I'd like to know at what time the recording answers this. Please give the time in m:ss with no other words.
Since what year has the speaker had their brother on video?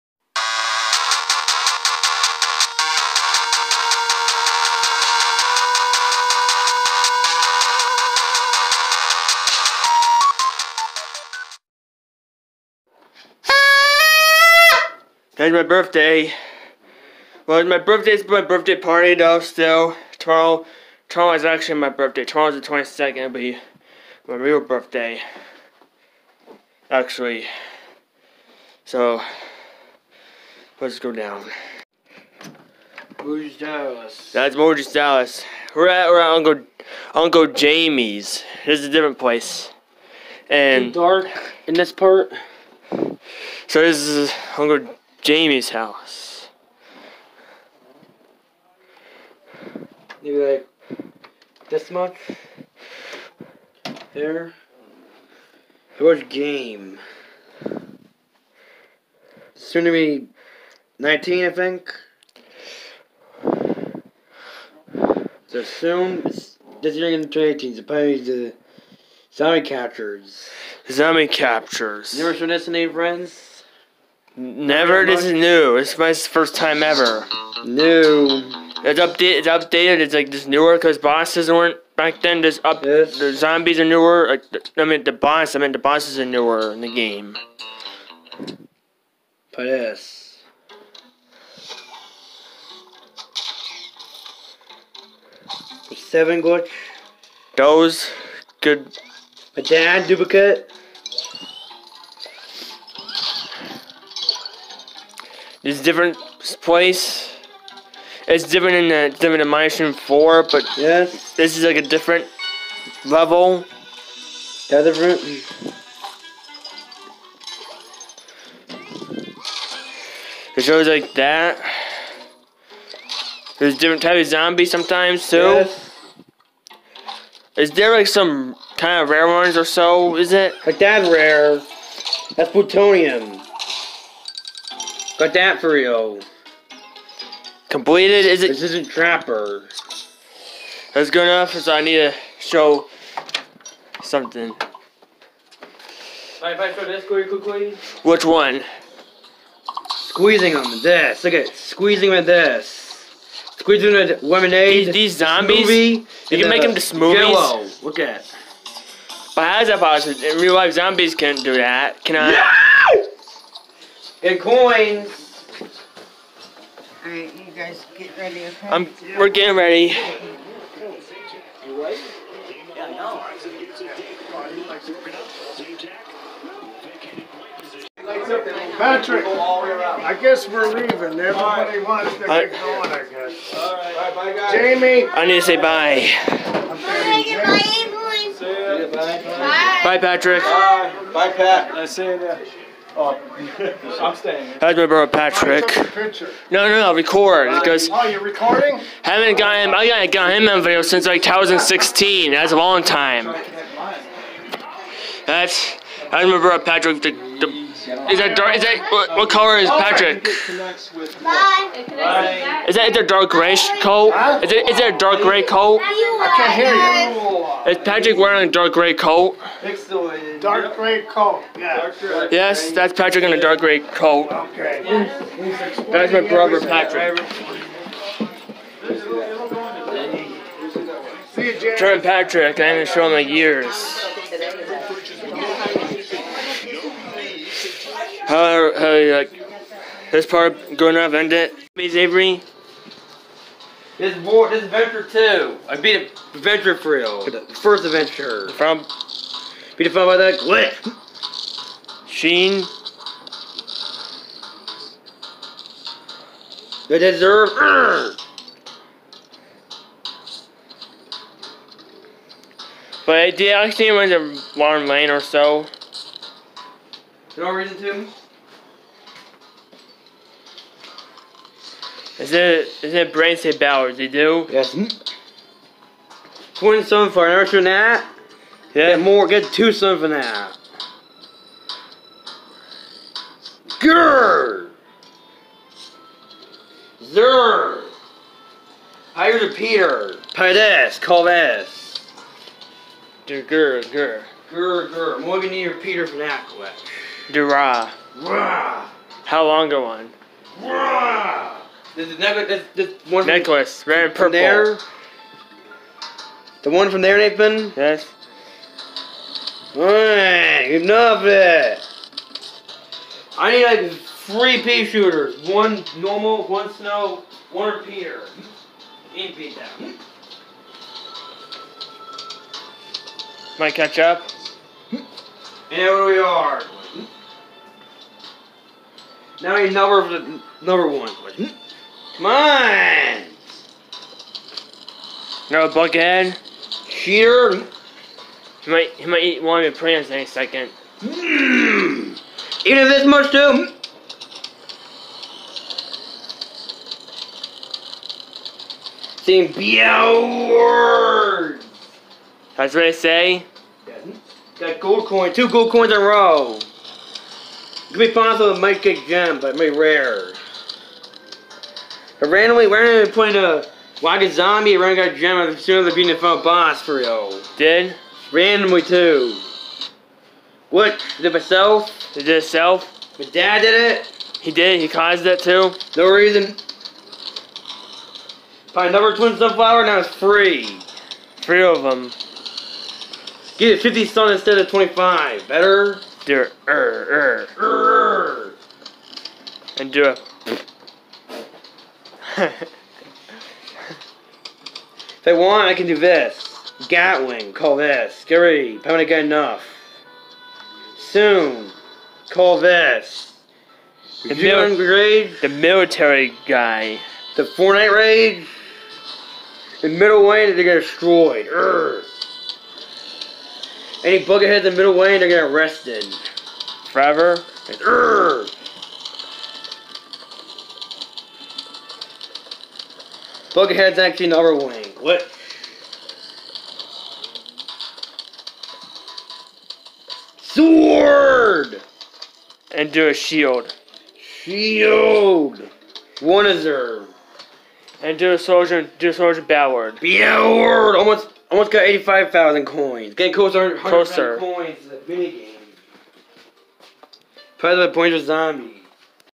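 3:21.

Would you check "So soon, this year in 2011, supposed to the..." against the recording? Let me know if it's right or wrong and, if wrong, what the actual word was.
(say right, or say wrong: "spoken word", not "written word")
wrong: "2018", not "2011".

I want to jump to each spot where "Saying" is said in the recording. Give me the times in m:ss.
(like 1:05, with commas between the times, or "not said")
5:49.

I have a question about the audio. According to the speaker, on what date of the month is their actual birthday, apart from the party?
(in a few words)
22nd.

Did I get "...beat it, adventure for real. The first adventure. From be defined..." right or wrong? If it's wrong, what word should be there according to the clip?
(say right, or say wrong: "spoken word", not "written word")
right.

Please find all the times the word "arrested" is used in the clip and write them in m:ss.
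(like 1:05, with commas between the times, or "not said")
6:55.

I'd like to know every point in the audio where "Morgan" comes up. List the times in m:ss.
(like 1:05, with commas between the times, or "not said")
0:34, 4:55.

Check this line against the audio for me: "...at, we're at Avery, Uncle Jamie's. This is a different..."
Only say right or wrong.
wrong.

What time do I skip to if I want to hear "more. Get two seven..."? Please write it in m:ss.
4:38.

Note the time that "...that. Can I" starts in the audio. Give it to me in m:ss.
2:41.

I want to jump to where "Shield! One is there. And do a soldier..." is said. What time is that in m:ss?
7:14.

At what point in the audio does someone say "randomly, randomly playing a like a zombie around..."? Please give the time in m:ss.
6:02.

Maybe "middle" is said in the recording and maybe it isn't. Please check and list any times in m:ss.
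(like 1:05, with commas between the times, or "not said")
6:49, 6:54.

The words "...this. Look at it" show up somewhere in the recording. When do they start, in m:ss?
2:30.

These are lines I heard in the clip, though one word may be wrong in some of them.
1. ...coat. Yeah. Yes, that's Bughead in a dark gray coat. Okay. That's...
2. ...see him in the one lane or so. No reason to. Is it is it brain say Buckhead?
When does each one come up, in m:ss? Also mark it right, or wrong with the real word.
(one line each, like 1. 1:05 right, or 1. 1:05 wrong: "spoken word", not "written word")
1. 3:41 wrong: "Patrick", not "Bughead"
2. 4:23 wrong: "Bowers", not "Buckhead".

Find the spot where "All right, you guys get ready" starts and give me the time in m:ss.
2:47.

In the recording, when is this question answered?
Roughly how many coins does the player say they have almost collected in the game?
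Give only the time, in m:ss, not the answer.
7:21.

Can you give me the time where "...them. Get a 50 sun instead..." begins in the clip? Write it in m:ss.
6:21.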